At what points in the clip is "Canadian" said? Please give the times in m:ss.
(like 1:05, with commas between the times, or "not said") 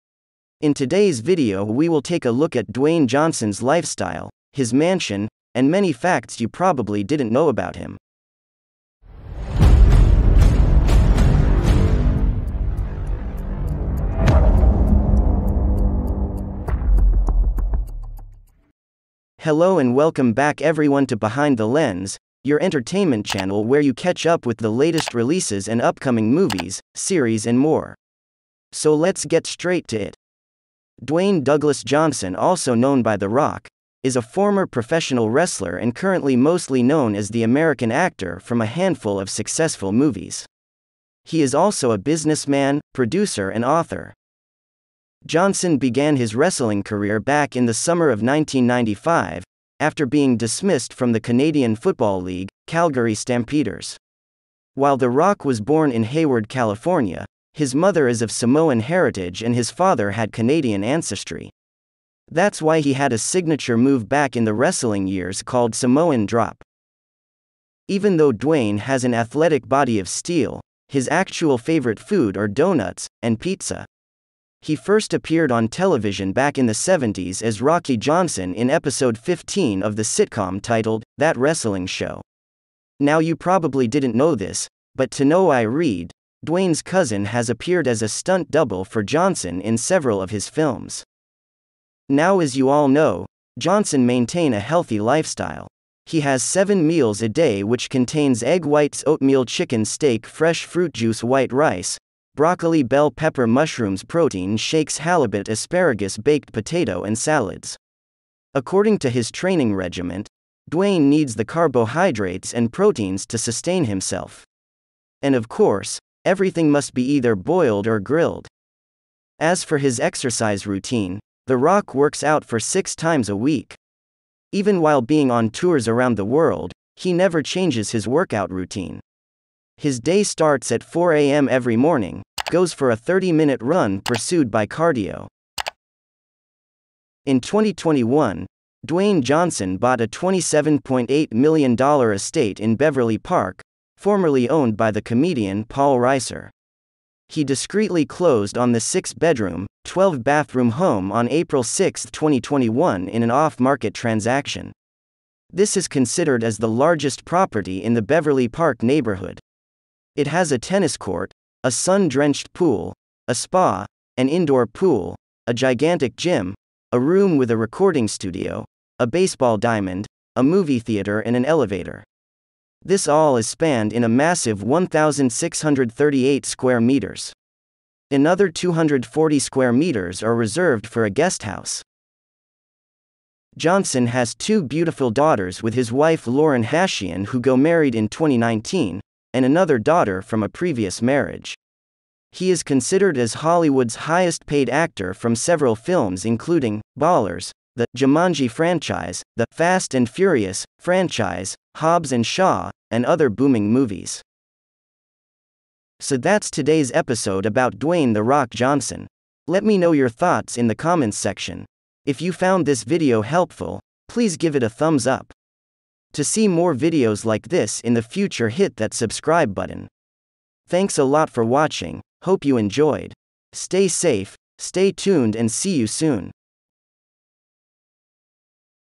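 0:51, 1:00.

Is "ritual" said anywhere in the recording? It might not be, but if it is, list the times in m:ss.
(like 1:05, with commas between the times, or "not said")
not said.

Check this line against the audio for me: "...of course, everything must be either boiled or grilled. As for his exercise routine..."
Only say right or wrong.
right.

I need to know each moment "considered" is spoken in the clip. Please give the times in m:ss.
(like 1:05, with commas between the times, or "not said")
2:35, 3:12.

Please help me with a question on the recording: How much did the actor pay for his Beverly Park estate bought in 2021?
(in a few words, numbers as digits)
$27.8 million.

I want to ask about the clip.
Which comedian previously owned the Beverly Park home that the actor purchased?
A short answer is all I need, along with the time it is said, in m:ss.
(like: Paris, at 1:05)
Paul Reiser, at 2:25.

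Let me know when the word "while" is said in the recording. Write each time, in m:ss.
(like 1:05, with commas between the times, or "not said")
0:54, 2:04.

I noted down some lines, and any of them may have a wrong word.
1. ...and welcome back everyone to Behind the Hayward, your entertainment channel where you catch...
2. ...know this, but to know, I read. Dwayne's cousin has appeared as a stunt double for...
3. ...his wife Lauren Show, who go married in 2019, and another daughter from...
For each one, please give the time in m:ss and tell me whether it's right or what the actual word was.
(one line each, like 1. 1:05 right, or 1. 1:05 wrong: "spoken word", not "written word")
1. 0:19 wrong: "Lens", not "Hayward"
2. 1:24 right
3. 3:05 wrong: "Hashian", not "Show".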